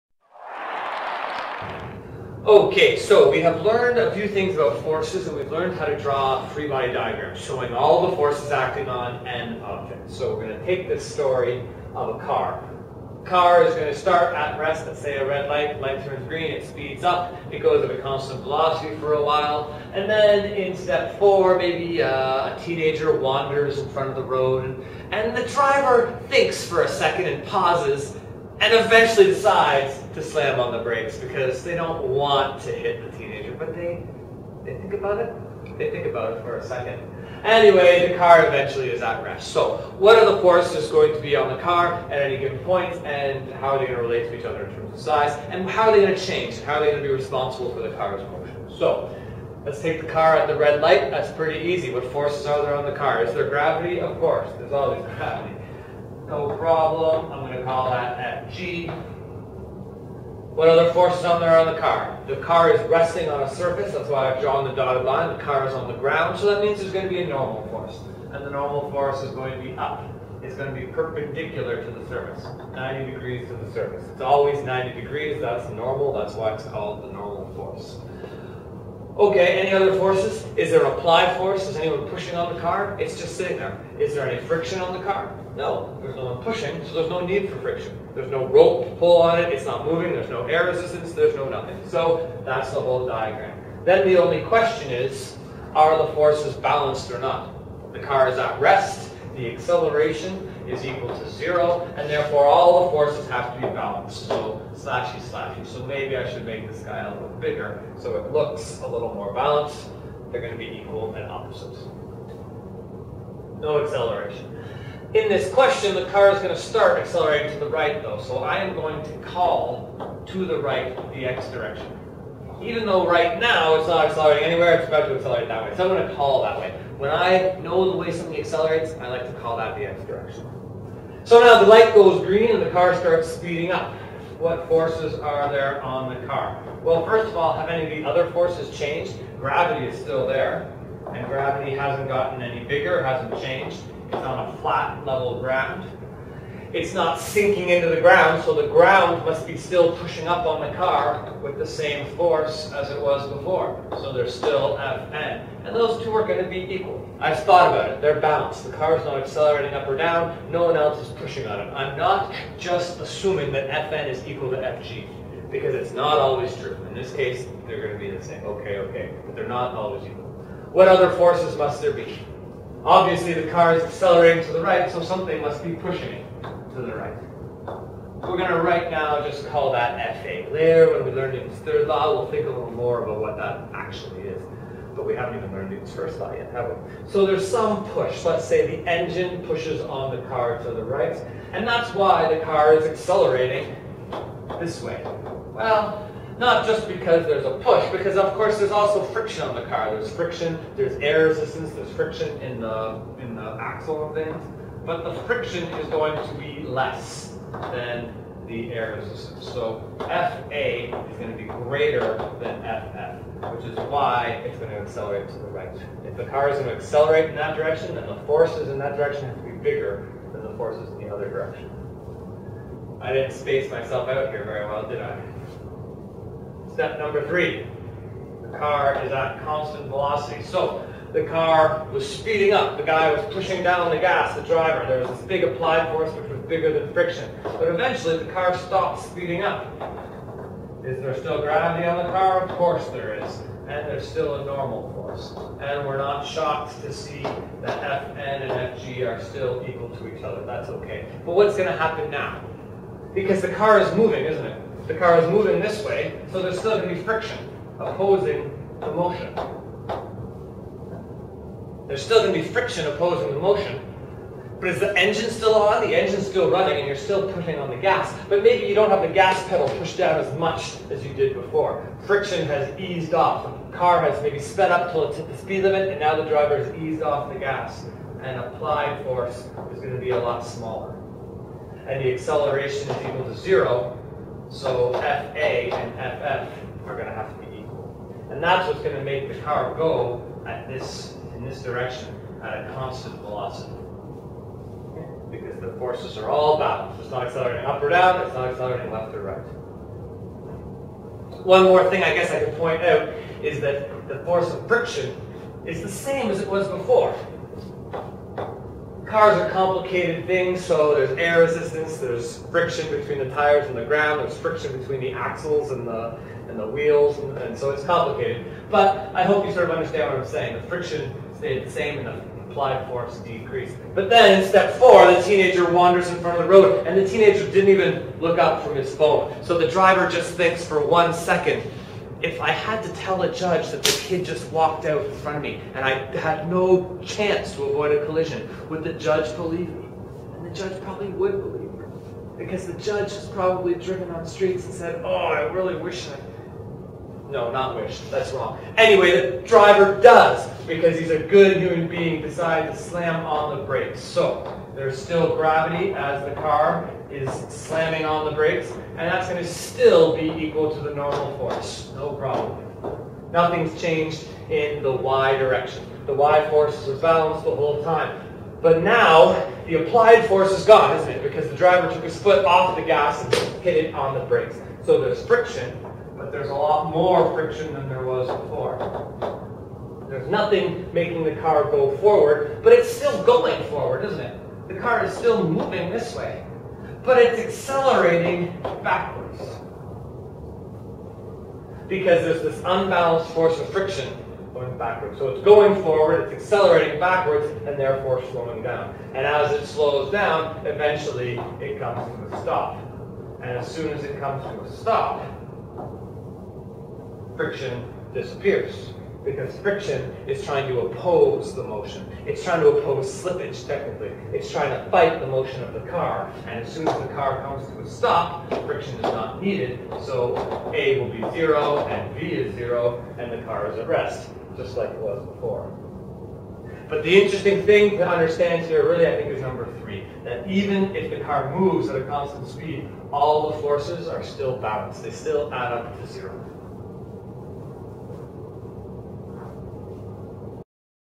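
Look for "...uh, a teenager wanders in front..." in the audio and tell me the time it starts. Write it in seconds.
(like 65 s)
22 s.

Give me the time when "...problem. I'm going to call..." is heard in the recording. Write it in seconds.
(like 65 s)
56 s.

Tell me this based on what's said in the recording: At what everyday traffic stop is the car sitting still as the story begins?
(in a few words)
A red light.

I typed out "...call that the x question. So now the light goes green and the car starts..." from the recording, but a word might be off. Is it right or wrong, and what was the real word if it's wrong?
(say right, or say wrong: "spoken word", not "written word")
wrong: "direction", not "question".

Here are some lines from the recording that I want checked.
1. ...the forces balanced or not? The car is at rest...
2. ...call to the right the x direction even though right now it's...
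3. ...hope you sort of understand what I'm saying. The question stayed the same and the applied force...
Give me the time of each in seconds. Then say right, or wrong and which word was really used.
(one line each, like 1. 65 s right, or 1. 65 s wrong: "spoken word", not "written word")
1. 96 s right
2. 119 s right
3. 319 s wrong: "friction", not "question".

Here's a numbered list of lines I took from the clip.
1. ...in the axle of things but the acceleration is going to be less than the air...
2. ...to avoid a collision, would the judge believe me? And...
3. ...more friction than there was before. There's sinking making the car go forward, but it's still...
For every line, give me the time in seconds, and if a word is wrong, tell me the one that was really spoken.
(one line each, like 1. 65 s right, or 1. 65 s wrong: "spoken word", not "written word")
1. 203 s wrong: "friction", not "acceleration"
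2. 337 s right
3. 376 s wrong: "nothing", not "sinking".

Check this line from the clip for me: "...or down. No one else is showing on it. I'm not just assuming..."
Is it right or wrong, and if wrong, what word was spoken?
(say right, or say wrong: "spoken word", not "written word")
wrong: "pushing", not "showing".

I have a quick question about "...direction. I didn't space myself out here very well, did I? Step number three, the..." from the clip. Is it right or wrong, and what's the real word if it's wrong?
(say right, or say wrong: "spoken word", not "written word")
right.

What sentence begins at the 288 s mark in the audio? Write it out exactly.
And that's what's going to make the car go at this in this direction at a constant velocity.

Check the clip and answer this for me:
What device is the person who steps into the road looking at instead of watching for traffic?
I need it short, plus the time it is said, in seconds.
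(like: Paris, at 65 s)
His phone, at 328 s.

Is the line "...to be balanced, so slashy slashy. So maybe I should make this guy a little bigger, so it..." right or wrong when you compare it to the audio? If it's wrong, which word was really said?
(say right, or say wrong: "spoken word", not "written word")
right.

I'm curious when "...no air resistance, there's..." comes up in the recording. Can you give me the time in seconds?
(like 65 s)
90 s.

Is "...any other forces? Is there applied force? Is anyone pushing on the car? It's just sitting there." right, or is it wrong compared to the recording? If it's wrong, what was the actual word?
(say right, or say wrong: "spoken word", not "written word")
right.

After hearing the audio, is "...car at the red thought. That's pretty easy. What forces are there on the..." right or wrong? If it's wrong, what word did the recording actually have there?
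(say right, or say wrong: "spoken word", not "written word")
wrong: "light", not "thought".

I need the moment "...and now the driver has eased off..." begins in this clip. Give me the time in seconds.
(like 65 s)
275 s.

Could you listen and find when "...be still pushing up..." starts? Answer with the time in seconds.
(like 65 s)
149 s.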